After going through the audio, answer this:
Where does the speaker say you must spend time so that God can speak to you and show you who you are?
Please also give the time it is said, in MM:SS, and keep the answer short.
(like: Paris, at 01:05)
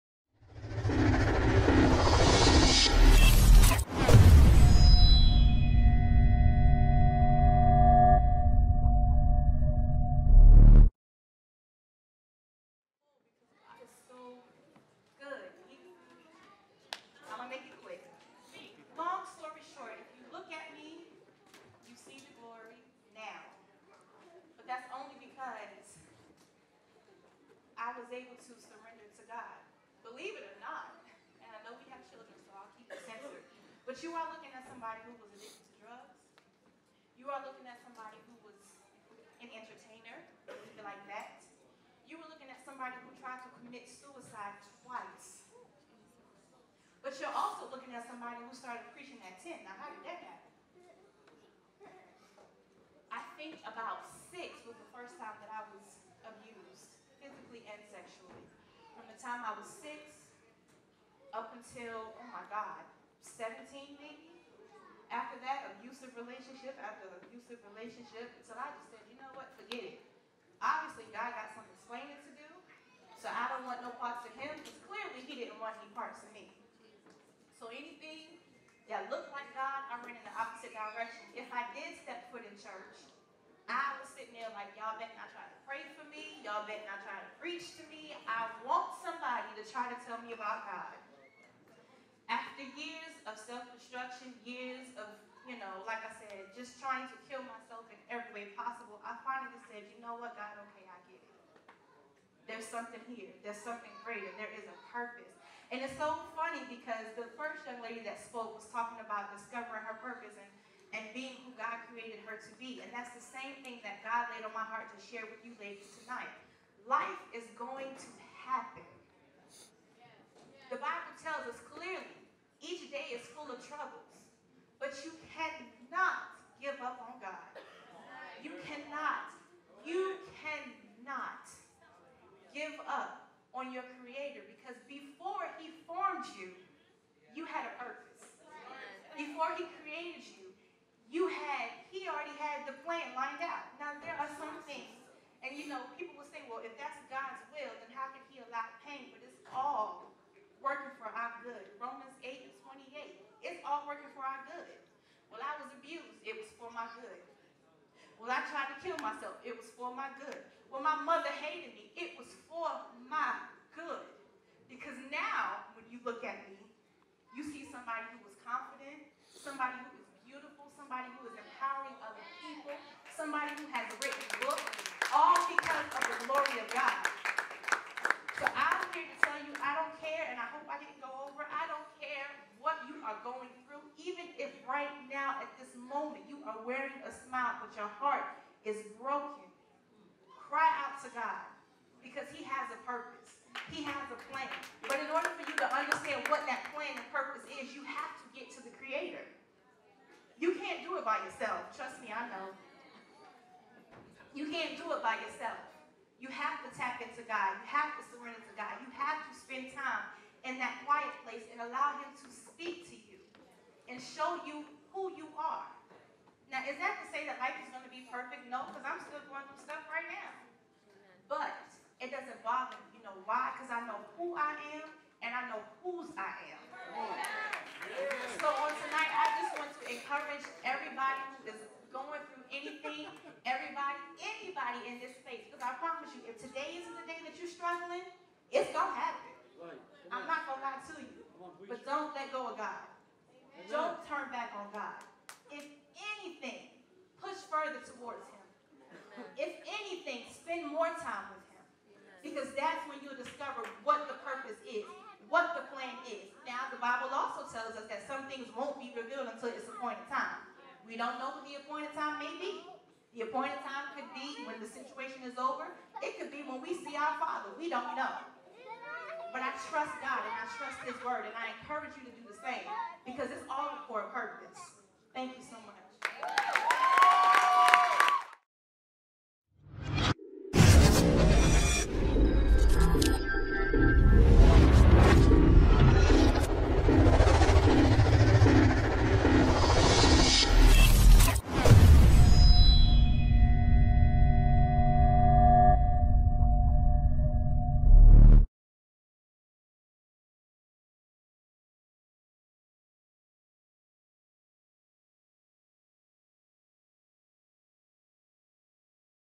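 quiet place, at 03:30.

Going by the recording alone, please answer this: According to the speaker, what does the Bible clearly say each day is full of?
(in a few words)
troubles.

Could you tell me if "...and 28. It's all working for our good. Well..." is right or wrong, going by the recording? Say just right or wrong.
right.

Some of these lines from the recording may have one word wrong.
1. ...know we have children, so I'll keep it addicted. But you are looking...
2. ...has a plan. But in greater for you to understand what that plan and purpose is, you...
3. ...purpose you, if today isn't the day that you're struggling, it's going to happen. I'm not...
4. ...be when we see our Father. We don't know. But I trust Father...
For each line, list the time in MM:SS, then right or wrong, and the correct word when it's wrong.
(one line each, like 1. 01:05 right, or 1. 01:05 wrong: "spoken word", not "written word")
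1. 00:31 wrong: "censored", not "addicted"
2. 03:13 wrong: "order", not "greater"
3. 03:55 wrong: "promise", not "purpose"
4. 04:26 wrong: "God", not "Father".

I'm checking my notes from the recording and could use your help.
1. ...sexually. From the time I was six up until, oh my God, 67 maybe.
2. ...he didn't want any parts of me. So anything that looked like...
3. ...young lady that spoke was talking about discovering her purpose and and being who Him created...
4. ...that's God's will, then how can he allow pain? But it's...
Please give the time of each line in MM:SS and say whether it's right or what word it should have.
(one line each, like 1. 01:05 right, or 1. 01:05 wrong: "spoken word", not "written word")
1. 00:57 wrong: "17", not "67"
2. 01:15 right
3. 01:47 wrong: "God", not "Him"
4. 02:26 right.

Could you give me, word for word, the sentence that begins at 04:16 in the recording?
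Now, the Bible also tells us that some things won't be revealed until its appointed time.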